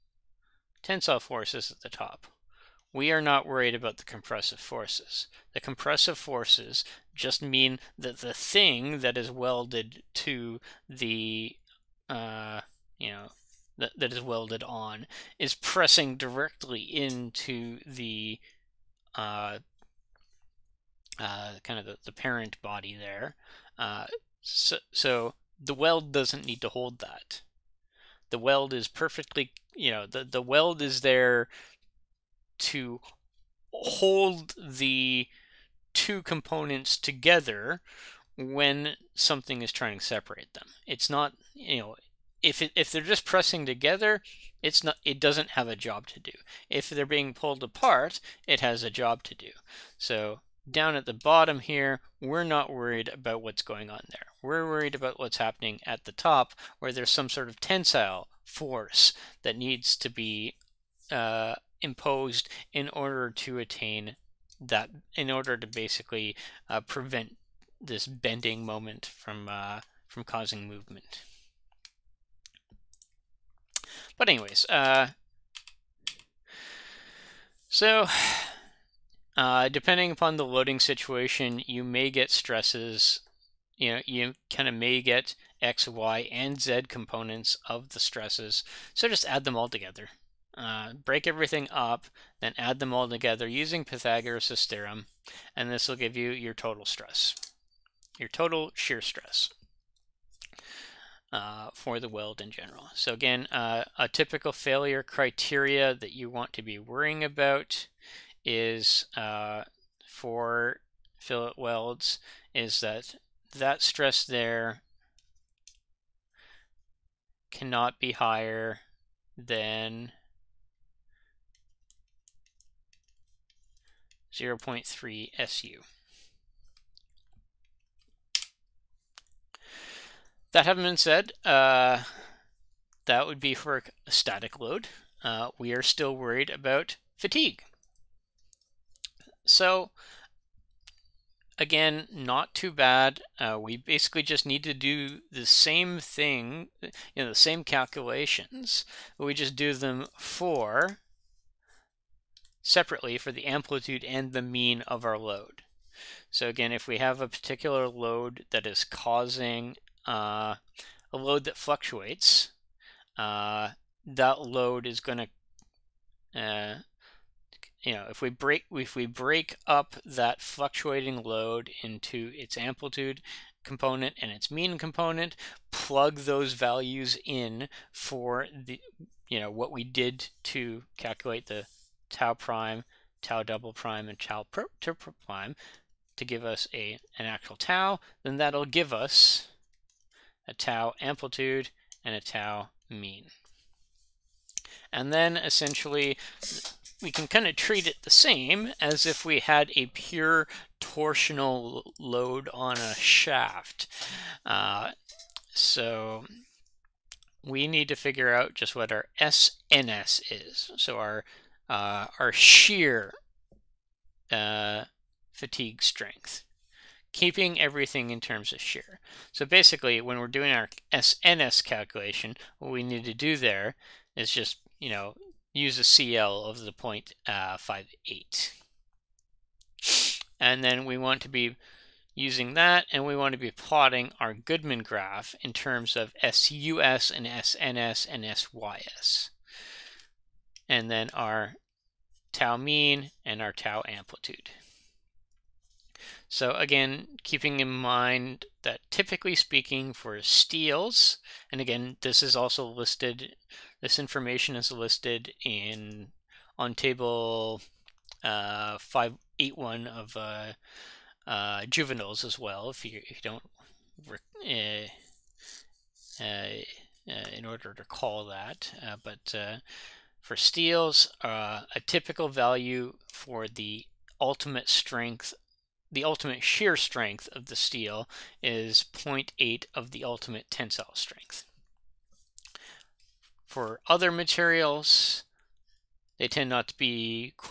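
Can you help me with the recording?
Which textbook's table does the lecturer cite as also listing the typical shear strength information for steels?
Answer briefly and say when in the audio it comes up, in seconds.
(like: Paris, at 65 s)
Juvinall's, at 261 s.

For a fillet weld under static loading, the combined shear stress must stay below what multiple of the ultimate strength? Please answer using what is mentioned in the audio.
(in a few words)
0.3 Su.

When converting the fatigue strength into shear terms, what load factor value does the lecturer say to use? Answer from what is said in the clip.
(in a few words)
0.58.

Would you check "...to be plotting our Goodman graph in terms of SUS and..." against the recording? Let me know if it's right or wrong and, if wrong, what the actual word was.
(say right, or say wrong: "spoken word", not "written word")
right.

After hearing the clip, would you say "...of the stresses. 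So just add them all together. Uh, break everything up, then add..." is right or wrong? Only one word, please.
right.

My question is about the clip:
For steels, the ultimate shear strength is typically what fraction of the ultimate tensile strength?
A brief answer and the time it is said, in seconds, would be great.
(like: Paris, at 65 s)
0.8, at 278 s.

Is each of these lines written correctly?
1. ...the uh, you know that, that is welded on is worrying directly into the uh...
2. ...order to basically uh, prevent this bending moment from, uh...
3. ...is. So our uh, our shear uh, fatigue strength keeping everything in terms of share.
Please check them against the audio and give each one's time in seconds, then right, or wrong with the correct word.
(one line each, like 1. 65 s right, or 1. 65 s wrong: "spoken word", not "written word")
1. 10 s wrong: "pressing", not "worrying"
2. 65 s right
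3. 210 s right.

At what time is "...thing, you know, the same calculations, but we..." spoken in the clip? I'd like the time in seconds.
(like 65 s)
146 s.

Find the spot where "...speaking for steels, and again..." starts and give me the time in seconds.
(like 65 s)
249 s.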